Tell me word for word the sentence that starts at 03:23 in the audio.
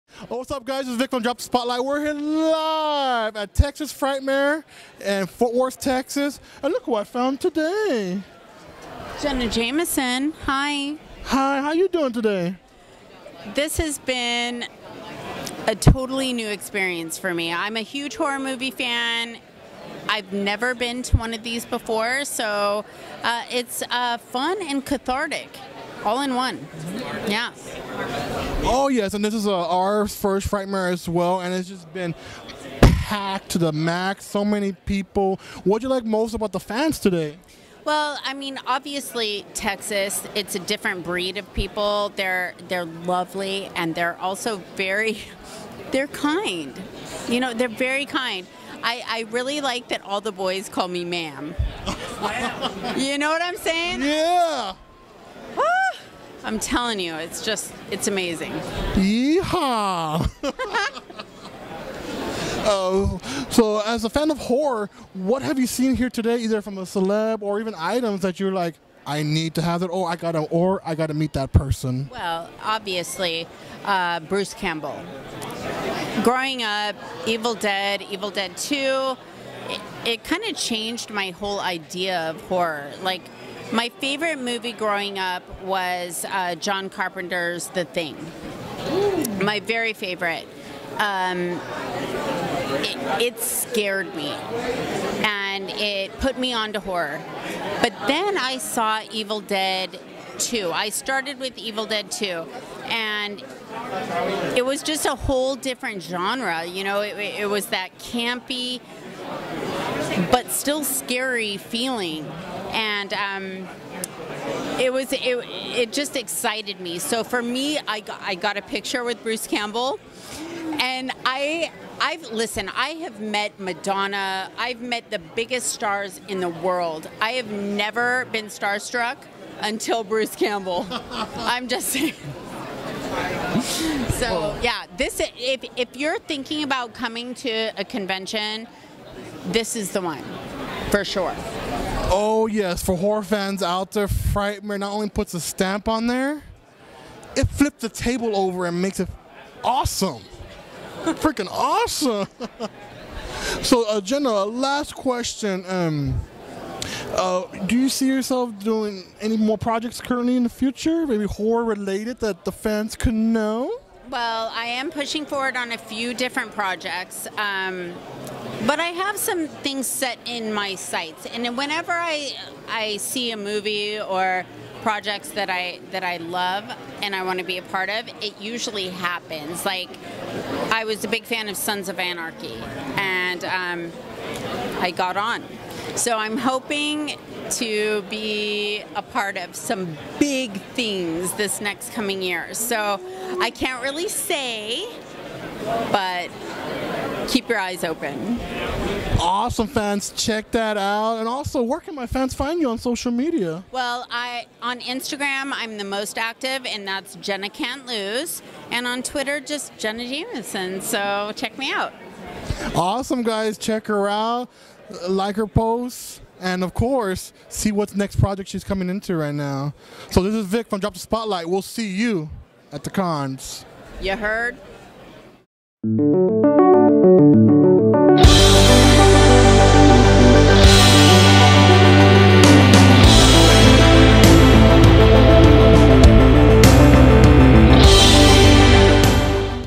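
Well, I on Instagram, I'm the most active, and that's Jenna Can't Lose.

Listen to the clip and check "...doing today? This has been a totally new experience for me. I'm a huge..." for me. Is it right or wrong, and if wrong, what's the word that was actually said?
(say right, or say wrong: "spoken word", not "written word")
right.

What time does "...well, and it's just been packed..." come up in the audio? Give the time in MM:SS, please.
00:31.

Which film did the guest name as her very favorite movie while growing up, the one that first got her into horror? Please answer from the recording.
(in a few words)
The Thing.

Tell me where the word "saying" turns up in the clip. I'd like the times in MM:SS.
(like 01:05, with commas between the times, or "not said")
00:53, 02:11.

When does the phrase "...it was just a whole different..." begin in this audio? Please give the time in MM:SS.
01:44.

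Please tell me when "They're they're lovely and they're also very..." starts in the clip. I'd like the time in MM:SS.
00:42.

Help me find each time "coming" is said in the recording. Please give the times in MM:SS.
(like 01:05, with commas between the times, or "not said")
02:16, 03:11, 03:38.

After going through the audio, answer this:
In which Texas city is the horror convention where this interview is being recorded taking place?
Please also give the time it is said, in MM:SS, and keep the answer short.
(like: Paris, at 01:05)
Fort Worth, at 00:05.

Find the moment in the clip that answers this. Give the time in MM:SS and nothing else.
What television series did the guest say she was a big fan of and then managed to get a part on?
03:01.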